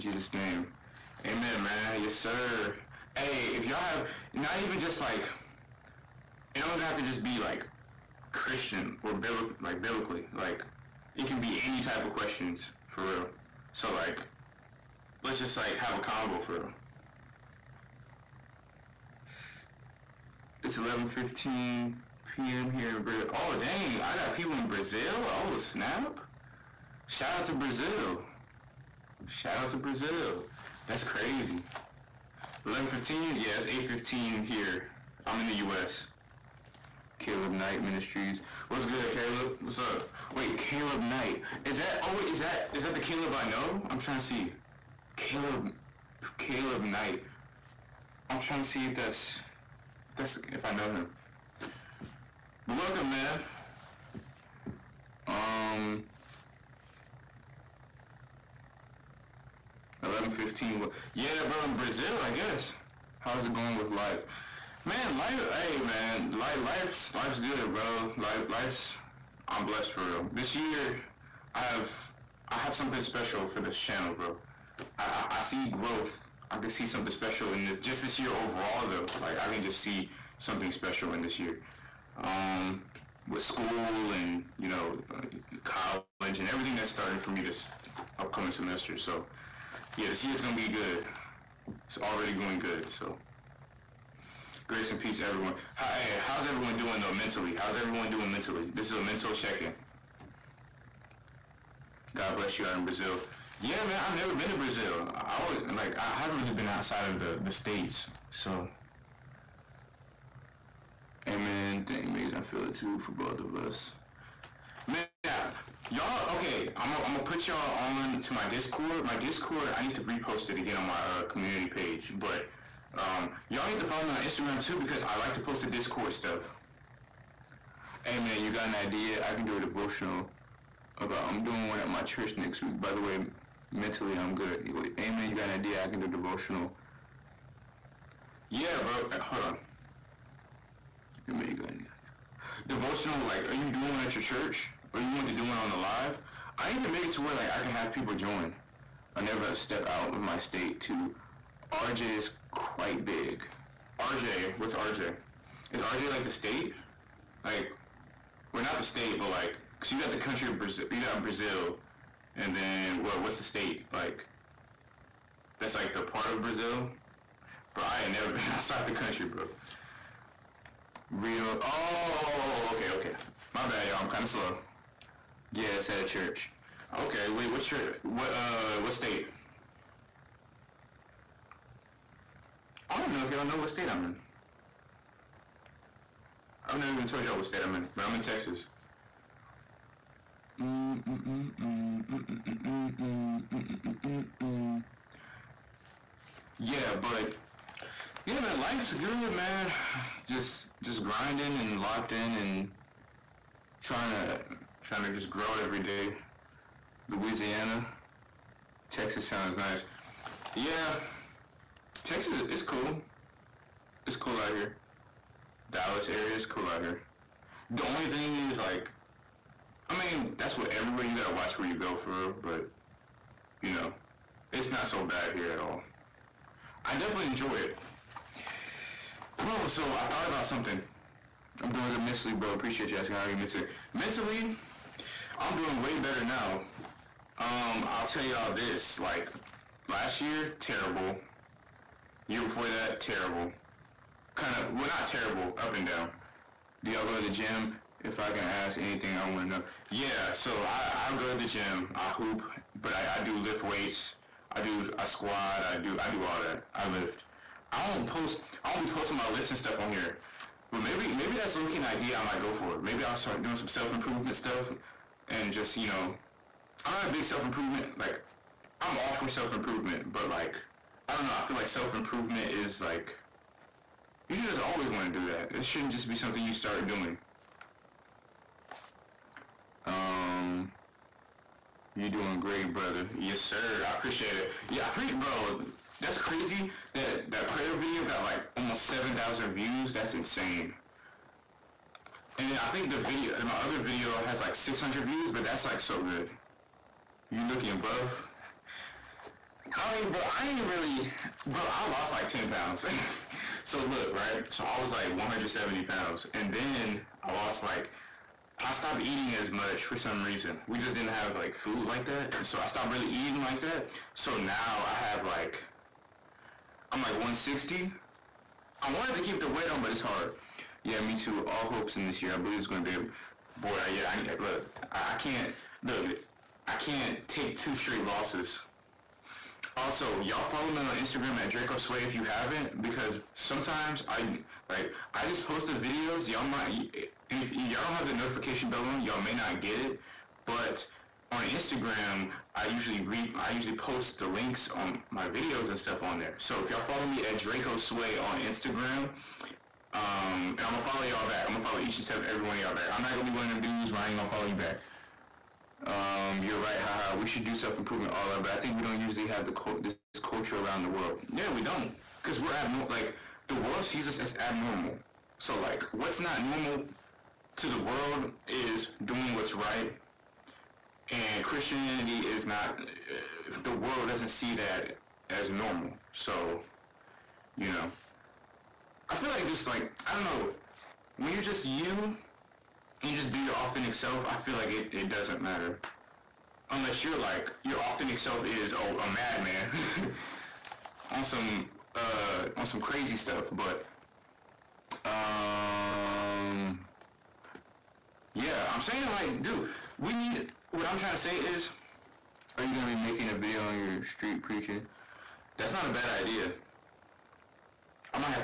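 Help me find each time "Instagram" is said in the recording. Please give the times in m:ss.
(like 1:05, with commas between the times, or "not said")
2:04, 5:30, 5:41, 5:48.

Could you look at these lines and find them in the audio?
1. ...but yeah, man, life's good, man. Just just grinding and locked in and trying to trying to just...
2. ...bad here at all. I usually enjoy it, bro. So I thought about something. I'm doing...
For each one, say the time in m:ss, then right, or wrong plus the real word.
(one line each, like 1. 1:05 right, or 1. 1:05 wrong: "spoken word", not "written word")
1. 3:16 right
2. 3:45 wrong: "definitely", not "usually".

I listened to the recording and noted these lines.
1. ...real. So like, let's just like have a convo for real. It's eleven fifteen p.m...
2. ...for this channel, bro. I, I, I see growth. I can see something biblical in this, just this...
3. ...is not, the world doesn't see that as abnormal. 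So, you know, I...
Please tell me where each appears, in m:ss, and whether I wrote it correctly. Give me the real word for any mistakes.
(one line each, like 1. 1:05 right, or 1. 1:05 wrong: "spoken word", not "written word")
1. 0:13 right
2. 1:13 wrong: "special", not "biblical"
3. 6:12 wrong: "normal", not "abnormal".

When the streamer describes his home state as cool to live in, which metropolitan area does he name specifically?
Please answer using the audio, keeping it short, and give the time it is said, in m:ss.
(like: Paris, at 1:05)
Dallas area, at 3:35.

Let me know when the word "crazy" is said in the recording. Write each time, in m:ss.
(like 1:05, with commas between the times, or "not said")
0:31, 4:46, 6:32.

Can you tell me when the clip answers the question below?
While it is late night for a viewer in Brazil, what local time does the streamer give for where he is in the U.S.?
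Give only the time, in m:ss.
0:33.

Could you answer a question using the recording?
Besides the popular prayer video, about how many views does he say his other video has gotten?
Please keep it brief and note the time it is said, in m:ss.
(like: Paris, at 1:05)
600, at 4:54.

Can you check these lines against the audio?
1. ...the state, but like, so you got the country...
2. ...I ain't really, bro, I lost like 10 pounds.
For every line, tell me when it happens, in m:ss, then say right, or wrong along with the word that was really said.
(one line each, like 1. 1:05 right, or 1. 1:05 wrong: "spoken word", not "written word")
1. 2:38 right
2. 5:00 right.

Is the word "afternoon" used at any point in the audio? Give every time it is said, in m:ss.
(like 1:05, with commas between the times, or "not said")
not said.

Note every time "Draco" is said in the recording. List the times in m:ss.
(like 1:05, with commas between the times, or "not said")
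5:31, 5:47.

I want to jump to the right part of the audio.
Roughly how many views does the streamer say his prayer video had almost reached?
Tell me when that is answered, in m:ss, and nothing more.
4:48.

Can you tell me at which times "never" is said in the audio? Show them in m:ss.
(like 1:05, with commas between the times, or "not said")
1:44, 2:29, 2:48, 3:06.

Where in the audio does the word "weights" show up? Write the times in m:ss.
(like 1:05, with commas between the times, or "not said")
4:13, 5:19.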